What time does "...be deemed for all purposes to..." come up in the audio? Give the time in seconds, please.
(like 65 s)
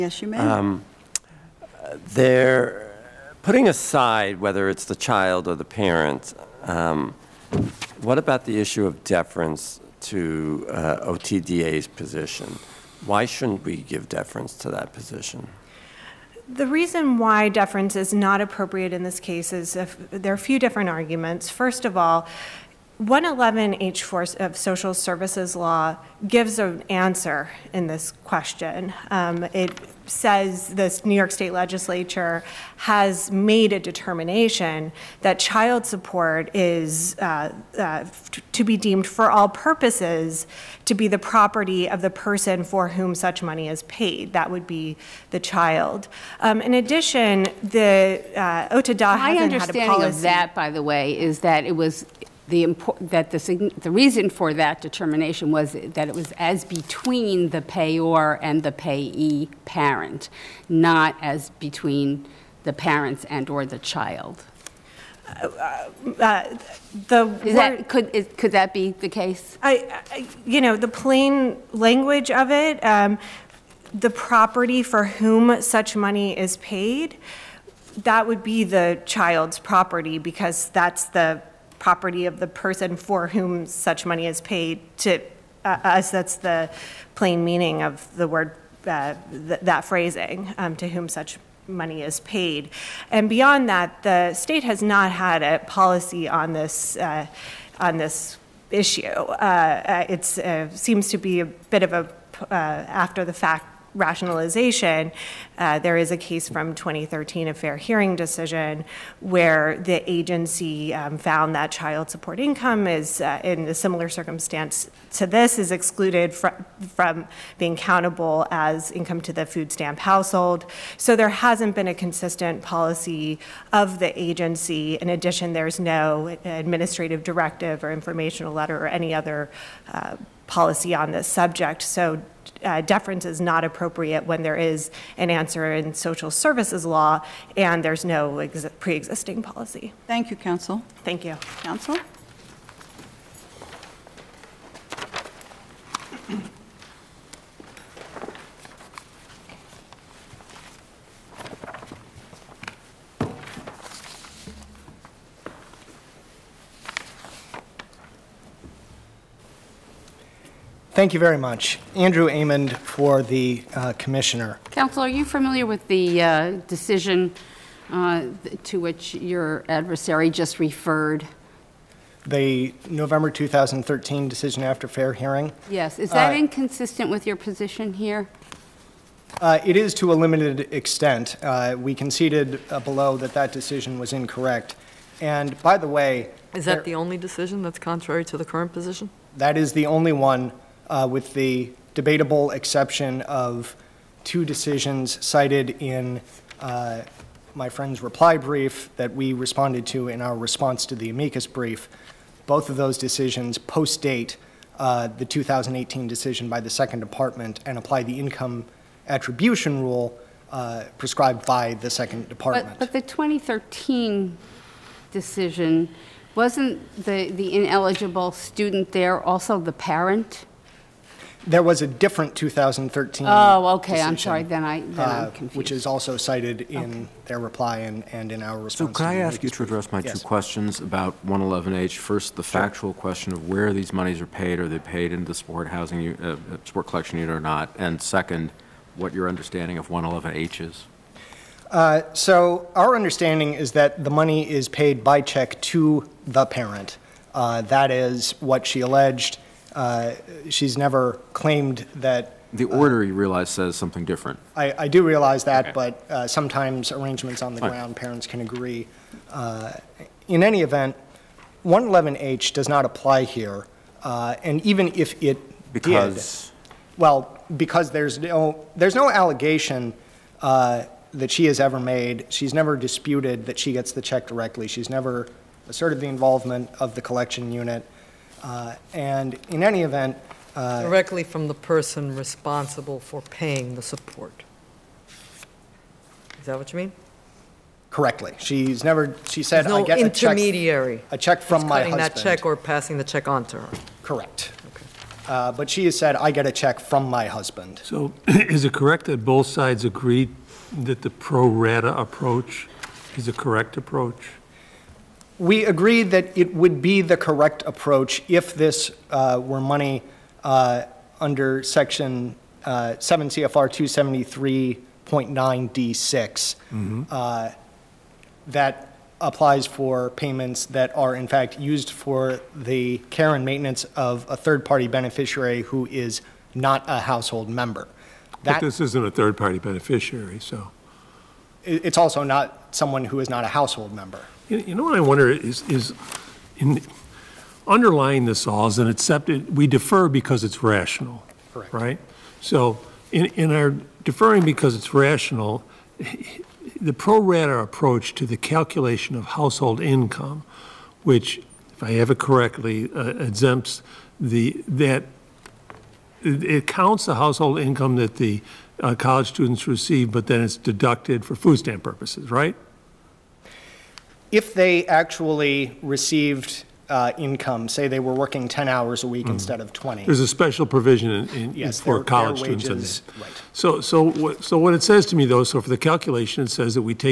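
38 s.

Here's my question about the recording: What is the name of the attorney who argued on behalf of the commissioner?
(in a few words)
Andrew Amend.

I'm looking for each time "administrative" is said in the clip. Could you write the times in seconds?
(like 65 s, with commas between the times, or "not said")
126 s.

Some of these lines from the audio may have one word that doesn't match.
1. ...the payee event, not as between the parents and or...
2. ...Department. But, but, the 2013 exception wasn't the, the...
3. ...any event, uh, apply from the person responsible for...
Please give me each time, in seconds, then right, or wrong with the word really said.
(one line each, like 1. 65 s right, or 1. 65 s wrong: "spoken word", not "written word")
1. 58 s wrong: "parent", not "event"
2. 212 s wrong: "decision", not "exception"
3. 279 s wrong: "directly", not "apply".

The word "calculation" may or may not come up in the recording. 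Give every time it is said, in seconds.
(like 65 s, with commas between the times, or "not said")
348 s, 375 s.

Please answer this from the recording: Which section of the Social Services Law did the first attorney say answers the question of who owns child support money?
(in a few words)
111H4.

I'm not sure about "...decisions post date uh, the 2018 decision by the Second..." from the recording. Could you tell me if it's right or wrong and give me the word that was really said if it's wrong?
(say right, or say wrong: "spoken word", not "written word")
right.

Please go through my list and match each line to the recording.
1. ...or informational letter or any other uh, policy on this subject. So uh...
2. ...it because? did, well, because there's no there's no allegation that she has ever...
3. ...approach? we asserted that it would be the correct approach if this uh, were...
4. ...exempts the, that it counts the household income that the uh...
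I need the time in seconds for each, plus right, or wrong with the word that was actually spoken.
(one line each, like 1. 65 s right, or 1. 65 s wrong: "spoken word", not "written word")
1. 127 s right
2. 265 s right
3. 303 s wrong: "agreed", not "asserted"
4. 353 s right.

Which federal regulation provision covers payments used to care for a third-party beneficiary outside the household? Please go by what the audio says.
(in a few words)
7 CFR 273.9 D6.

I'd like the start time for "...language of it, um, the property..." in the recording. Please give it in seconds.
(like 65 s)
71 s.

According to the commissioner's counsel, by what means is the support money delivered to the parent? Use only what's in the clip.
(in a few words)
By check.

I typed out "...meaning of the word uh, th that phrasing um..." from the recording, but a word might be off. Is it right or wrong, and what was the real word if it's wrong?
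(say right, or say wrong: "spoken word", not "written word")
right.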